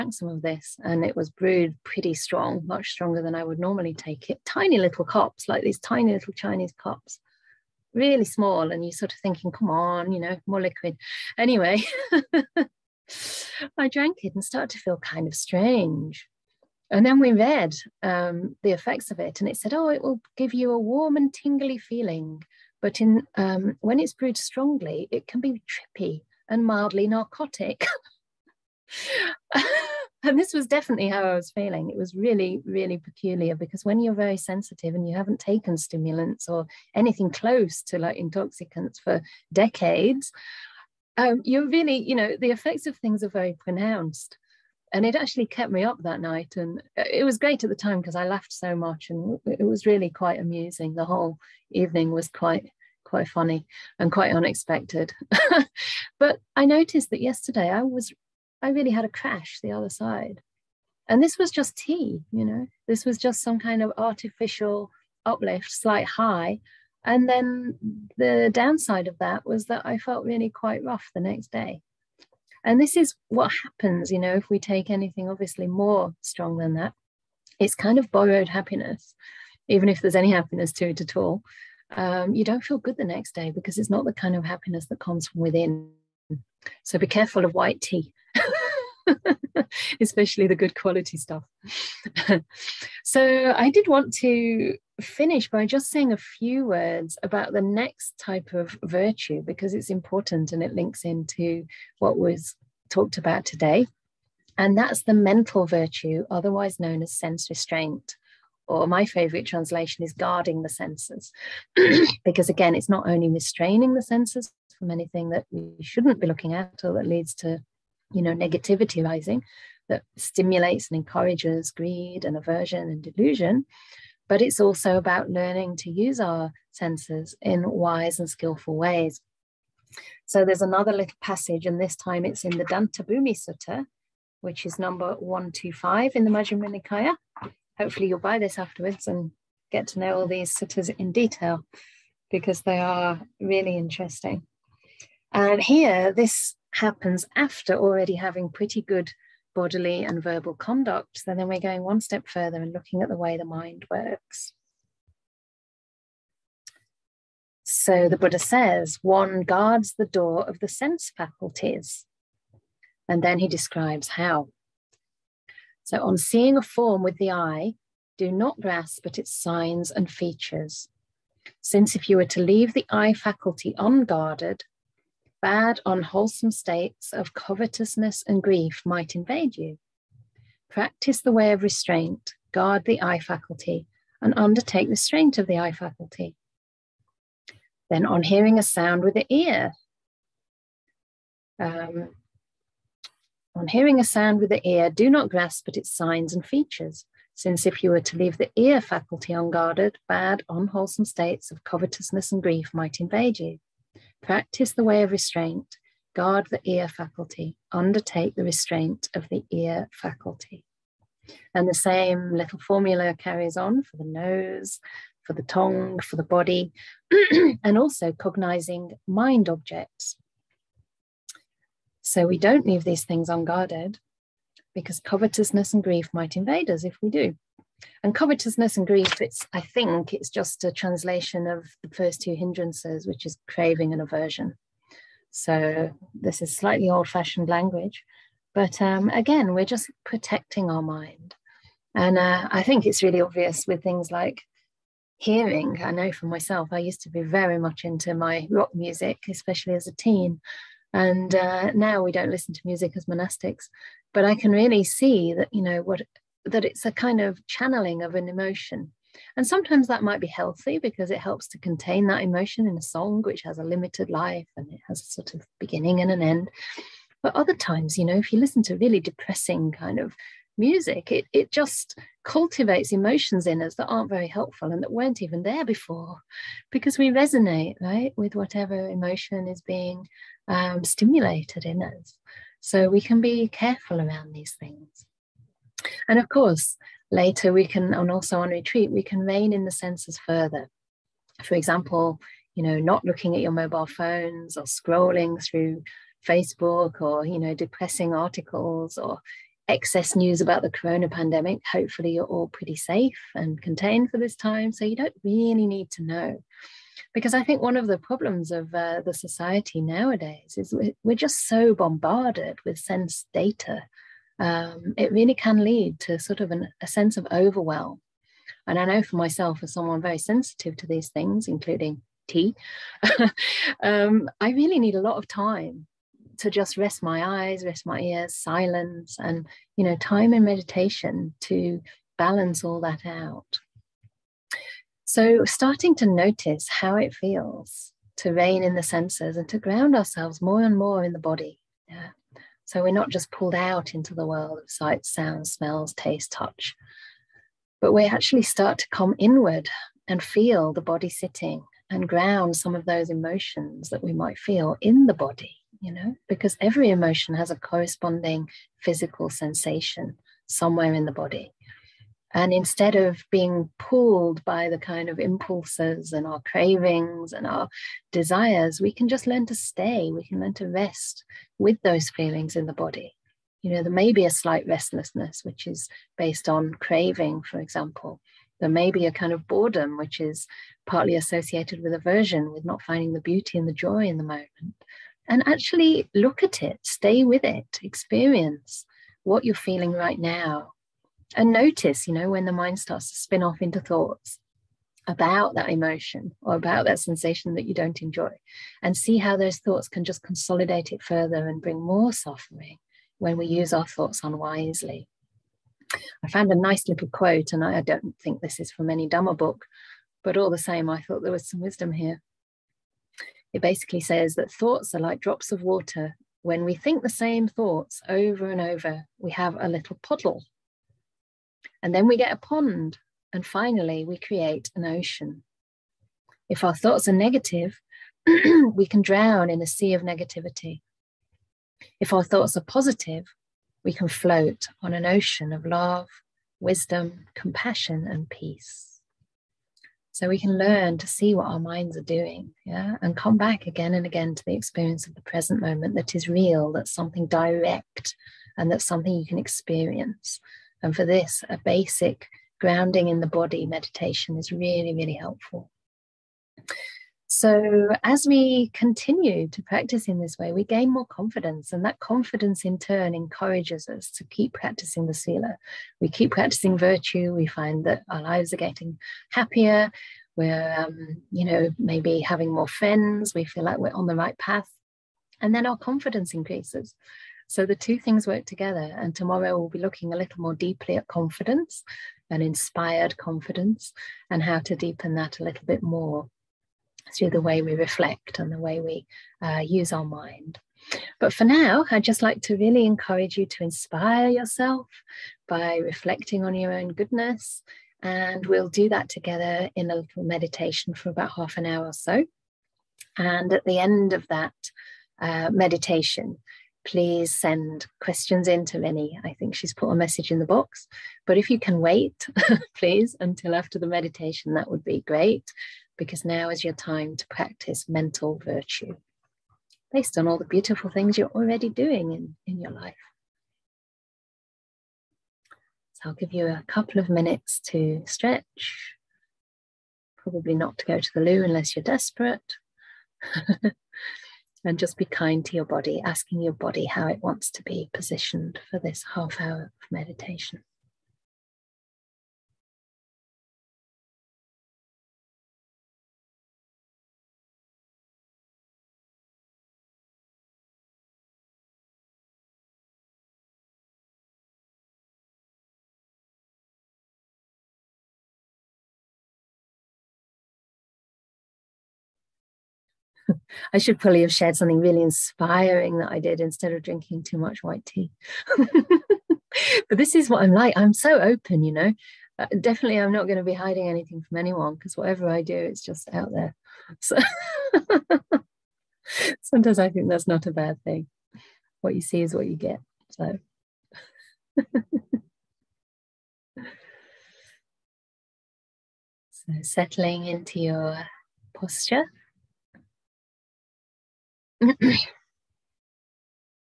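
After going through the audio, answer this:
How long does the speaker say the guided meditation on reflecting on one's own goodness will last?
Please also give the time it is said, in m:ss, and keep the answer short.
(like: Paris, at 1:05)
Half an hour, at 8:21.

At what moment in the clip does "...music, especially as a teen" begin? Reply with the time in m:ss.
4:08.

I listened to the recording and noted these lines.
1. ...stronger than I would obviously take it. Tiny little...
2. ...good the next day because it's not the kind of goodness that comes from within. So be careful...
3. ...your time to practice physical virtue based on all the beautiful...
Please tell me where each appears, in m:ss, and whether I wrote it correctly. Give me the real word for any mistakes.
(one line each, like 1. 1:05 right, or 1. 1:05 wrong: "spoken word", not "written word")
1. 0:02 wrong: "normally", not "obviously"
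2. 1:22 wrong: "happiness", not "goodness"
3. 8:36 wrong: "mental", not "physical".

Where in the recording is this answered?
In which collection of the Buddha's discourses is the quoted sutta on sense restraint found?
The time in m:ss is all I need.
2:16.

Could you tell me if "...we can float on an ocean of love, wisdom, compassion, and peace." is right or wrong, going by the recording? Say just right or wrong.
right.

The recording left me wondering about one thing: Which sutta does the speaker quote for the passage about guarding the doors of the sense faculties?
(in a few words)
Dantabhumi Sutta.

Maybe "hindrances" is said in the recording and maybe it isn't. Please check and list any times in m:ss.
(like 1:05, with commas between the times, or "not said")
3:52.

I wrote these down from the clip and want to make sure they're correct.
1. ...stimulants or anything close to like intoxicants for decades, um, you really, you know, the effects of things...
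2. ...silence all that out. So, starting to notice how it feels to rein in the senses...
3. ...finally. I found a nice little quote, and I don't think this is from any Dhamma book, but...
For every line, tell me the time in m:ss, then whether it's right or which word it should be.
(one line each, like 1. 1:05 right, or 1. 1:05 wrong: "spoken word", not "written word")
1. 0:35 right
2. 5:32 wrong: "balance", not "silence"
3. 6:44 wrong: "unwisely", not "finally".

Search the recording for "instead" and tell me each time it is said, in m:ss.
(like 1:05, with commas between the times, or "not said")
6:02, 9:26.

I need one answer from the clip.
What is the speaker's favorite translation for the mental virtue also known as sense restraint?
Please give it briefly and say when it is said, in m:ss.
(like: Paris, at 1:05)
Guarding the senses, at 1:50.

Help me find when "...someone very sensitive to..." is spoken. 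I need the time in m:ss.
5:19.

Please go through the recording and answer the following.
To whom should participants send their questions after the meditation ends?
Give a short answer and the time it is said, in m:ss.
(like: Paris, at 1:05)
Minnie, at 8:28.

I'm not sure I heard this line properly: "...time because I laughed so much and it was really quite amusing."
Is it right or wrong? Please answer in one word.
right.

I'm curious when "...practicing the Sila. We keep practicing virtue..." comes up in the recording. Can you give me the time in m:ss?
7:44.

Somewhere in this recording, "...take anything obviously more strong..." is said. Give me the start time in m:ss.
1:14.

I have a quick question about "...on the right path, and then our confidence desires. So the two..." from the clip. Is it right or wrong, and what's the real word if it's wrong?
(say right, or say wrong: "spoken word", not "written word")
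wrong: "increases", not "desires".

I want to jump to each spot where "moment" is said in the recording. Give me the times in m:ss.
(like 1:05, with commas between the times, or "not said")
6:24, 7:25.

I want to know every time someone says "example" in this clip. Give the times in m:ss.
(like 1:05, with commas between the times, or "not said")
4:51, 6:17.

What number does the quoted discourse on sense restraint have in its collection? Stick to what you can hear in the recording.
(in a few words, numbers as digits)
125.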